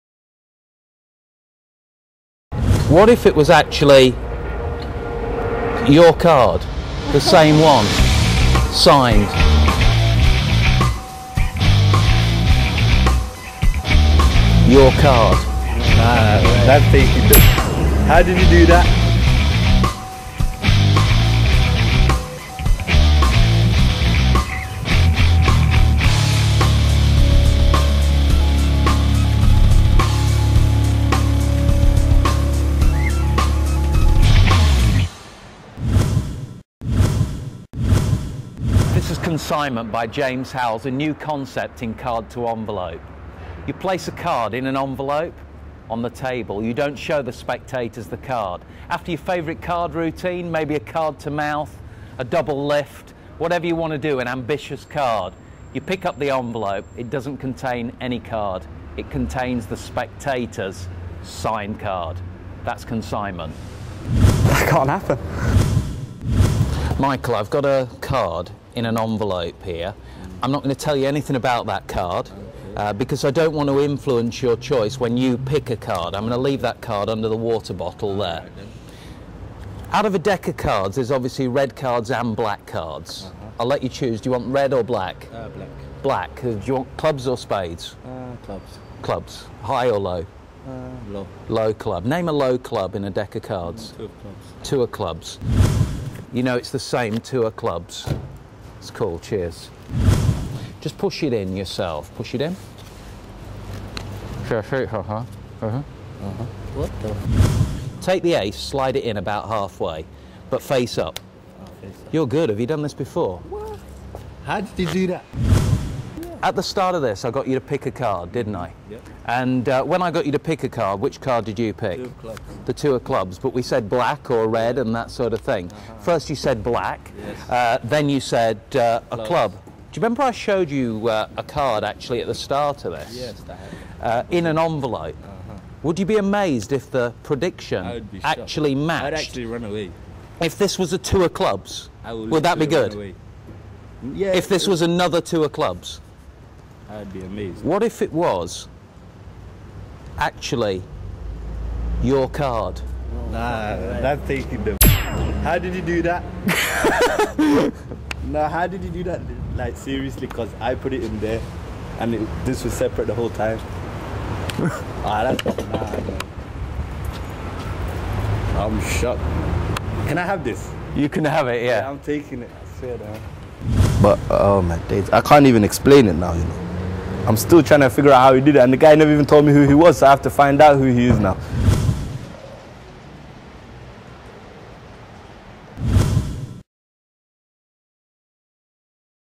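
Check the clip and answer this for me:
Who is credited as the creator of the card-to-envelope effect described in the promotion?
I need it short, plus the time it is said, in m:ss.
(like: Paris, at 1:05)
James Howells, at 0:40.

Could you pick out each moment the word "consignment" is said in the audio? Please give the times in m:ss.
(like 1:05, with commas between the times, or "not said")
0:39, 1:02.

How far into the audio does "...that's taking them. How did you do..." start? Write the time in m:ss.
2:34.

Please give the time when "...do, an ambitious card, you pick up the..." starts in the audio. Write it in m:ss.
0:53.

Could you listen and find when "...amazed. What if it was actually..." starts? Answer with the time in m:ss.
2:27.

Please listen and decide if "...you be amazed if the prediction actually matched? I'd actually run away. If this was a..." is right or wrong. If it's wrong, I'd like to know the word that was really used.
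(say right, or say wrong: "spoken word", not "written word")
right.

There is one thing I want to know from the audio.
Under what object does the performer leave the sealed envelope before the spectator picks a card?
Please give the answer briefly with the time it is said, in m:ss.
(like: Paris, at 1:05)
The water bottle, at 1:17.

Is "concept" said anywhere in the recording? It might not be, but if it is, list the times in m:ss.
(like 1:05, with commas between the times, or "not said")
0:41.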